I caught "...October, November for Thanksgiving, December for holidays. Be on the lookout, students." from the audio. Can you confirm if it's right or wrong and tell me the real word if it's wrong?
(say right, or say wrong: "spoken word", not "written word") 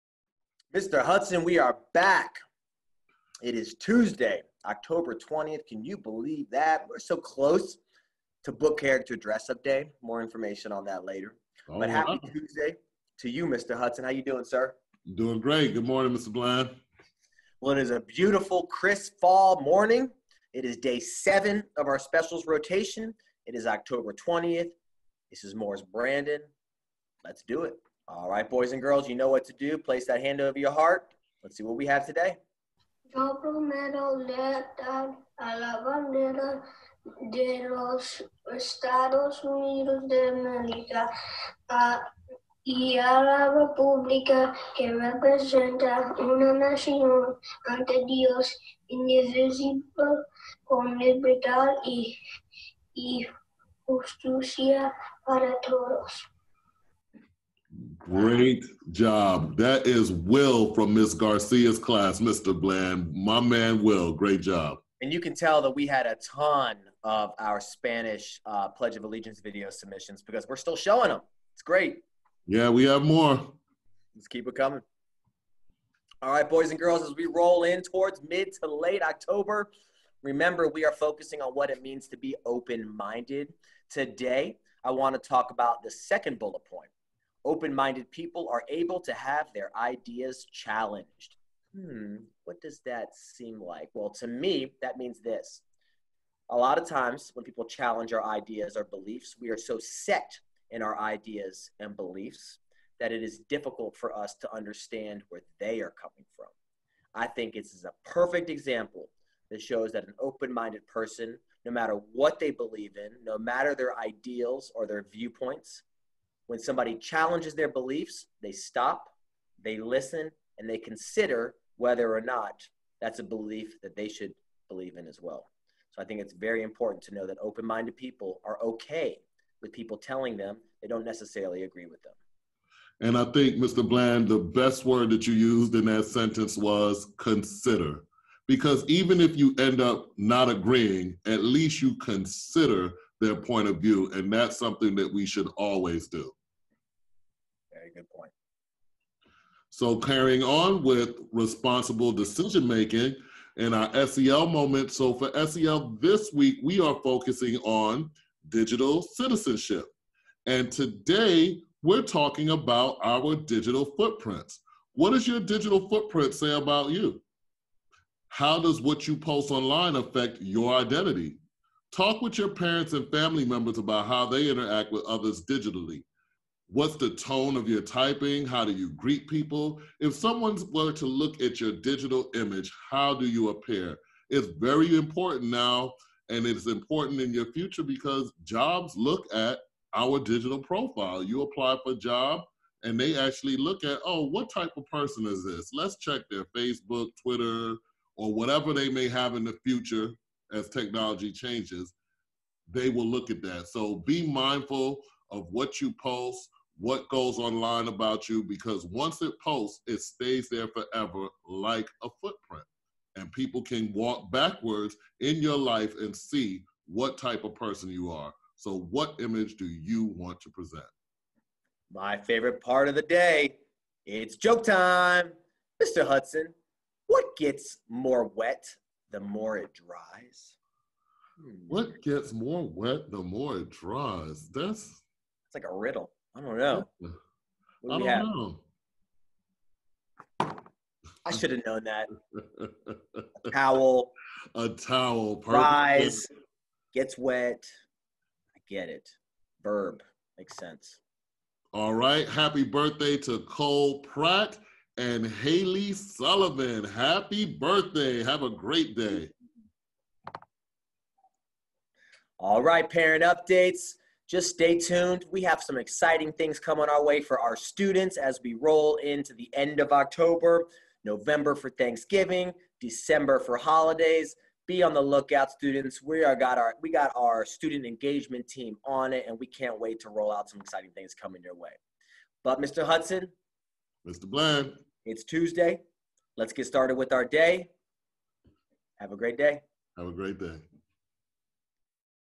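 right.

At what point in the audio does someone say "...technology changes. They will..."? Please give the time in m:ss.
3:20.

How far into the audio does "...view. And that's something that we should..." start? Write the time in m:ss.
2:23.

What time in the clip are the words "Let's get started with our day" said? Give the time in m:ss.
4:46.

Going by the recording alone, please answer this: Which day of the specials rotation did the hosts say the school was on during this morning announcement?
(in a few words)
Day 7.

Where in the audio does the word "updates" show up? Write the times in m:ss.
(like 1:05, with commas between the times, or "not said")
4:23.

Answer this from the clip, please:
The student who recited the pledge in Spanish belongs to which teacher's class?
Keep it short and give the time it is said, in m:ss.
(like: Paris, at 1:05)
Miss Garcia, at 1:00.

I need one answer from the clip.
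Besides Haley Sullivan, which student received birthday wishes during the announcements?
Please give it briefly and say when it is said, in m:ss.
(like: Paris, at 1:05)
Cole Pratt, at 4:13.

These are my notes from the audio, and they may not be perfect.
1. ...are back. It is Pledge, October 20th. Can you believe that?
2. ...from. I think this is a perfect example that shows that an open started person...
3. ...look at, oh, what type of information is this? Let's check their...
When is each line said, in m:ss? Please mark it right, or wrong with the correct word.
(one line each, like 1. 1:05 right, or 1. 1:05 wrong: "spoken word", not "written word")
1. 0:01 wrong: "Tuesday", not "Pledge"
2. 1:46 wrong: "minded", not "started"
3. 3:13 wrong: "person", not "information".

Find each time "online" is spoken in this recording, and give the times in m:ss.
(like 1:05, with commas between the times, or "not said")
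2:49, 3:27.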